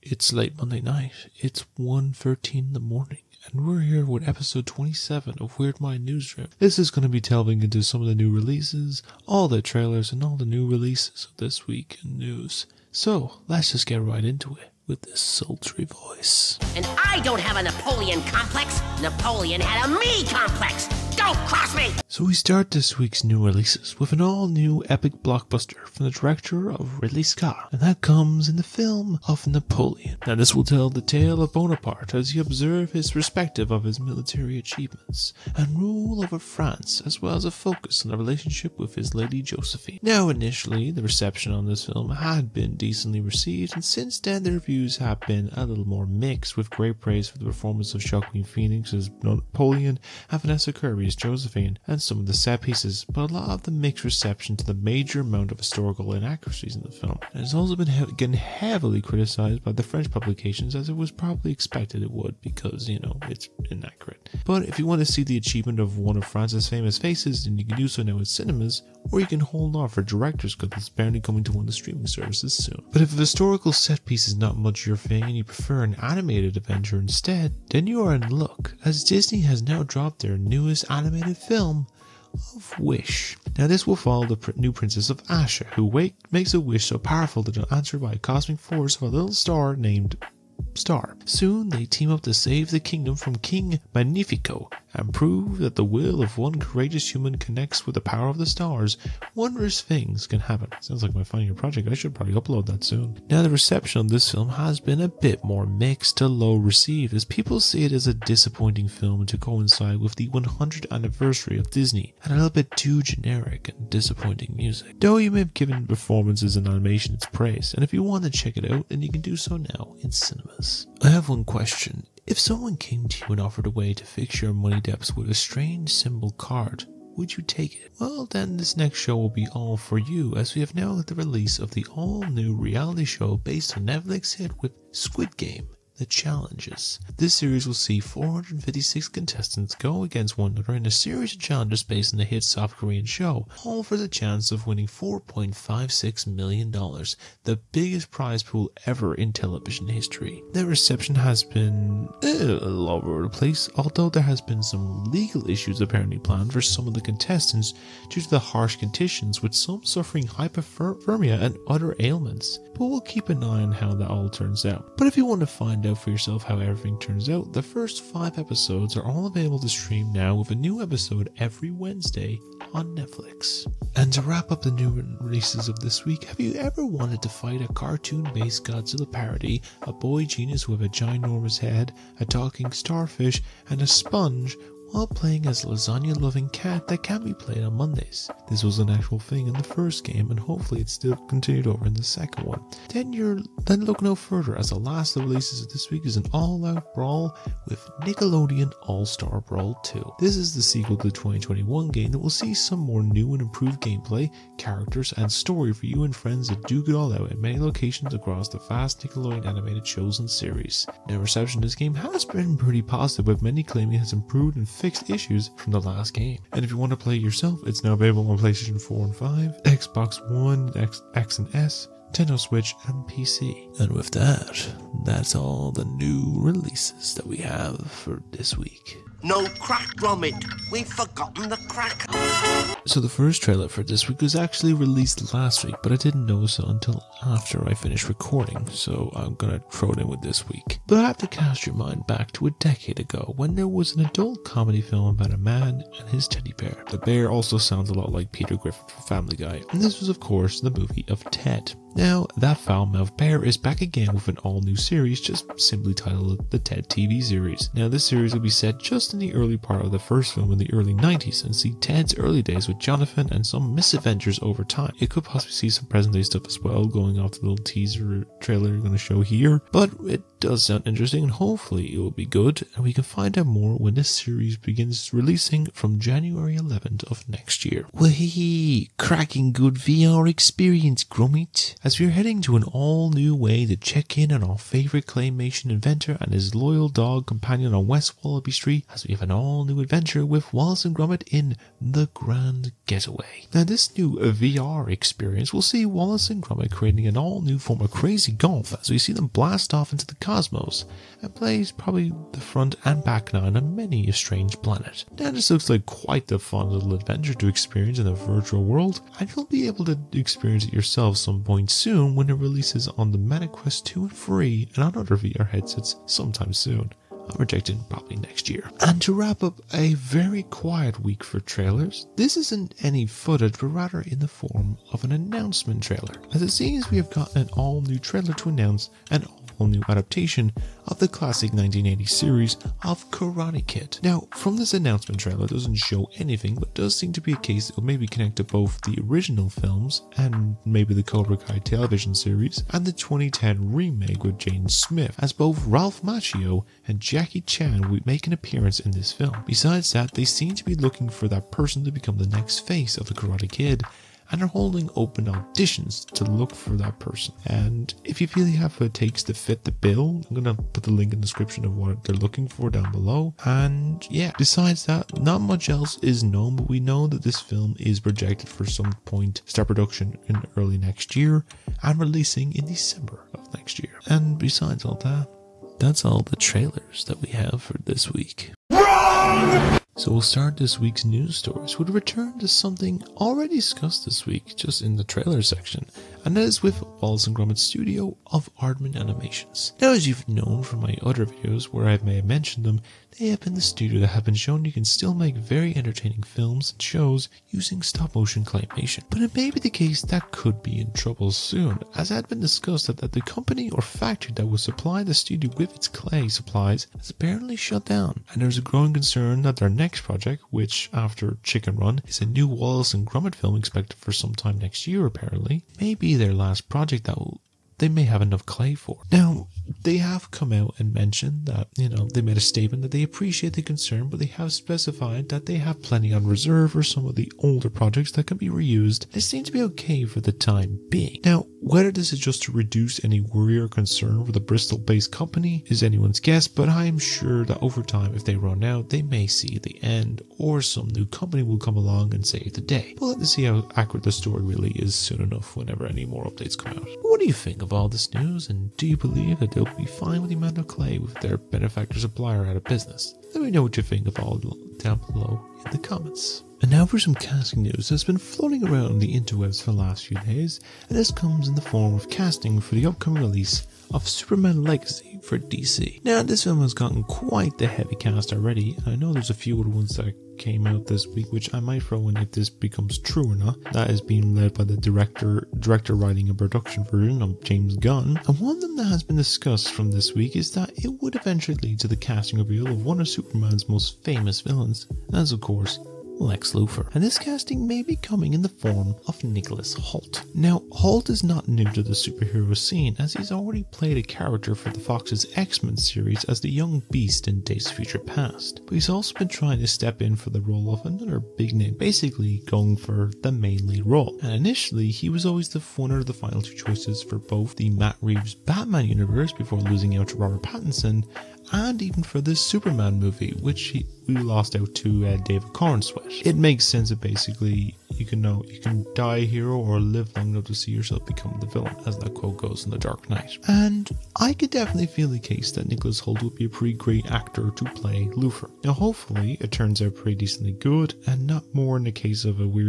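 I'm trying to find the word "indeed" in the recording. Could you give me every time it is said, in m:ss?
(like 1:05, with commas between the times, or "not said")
not said.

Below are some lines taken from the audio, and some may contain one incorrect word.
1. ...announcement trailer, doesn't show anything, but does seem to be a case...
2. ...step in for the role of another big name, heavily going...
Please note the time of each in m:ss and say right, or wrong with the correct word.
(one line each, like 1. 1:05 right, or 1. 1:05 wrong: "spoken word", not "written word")
1. 5:34 right
2. 8:19 wrong: "basically", not "heavily".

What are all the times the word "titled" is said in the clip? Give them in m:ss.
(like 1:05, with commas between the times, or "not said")
4:15.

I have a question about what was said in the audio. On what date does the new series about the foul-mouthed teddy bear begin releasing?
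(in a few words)
January 11th.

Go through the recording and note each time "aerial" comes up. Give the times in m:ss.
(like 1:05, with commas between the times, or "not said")
not said.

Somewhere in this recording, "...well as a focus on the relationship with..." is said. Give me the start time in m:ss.
0:37.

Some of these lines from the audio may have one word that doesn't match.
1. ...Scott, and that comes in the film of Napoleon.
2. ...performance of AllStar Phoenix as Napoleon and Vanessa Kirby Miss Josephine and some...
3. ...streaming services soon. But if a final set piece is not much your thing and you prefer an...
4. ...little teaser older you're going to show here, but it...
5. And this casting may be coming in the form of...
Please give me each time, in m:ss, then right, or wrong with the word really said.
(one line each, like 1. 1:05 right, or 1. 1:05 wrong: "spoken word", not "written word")
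1. 0:27 right
2. 0:47 wrong: "Joaquin", not "AllStar"
3. 1:11 wrong: "historical", not "final"
4. 4:27 wrong: "trailer", not "older"
5. 8:06 right.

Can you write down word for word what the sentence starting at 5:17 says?
I'm uh, projecting probably next year.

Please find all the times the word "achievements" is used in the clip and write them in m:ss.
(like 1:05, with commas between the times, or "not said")
0:34, 1:05.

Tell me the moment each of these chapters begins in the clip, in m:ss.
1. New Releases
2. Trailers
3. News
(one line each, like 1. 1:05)
1. 0:15
2. 3:47
3. 6:16.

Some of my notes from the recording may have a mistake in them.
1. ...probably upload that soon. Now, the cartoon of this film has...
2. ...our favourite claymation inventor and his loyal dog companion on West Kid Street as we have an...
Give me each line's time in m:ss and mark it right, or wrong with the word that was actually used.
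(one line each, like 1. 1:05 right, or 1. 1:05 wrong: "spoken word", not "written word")
1. 1:42 wrong: "reception", not "cartoon"
2. 4:44 wrong: "Wallaby", not "Kid".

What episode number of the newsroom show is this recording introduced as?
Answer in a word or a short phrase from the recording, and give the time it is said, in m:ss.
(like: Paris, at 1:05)
27, at 0:04.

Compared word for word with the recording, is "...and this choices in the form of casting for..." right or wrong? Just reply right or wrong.
wrong.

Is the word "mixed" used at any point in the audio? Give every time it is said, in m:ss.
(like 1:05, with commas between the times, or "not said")
0:46, 0:53, 1:45.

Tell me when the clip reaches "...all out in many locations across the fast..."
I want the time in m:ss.
3:26.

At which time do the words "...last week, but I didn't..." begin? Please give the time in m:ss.
3:55.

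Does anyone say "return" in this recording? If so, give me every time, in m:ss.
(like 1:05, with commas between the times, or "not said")
6:21.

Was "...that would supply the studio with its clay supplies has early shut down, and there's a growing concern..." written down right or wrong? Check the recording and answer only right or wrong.
wrong.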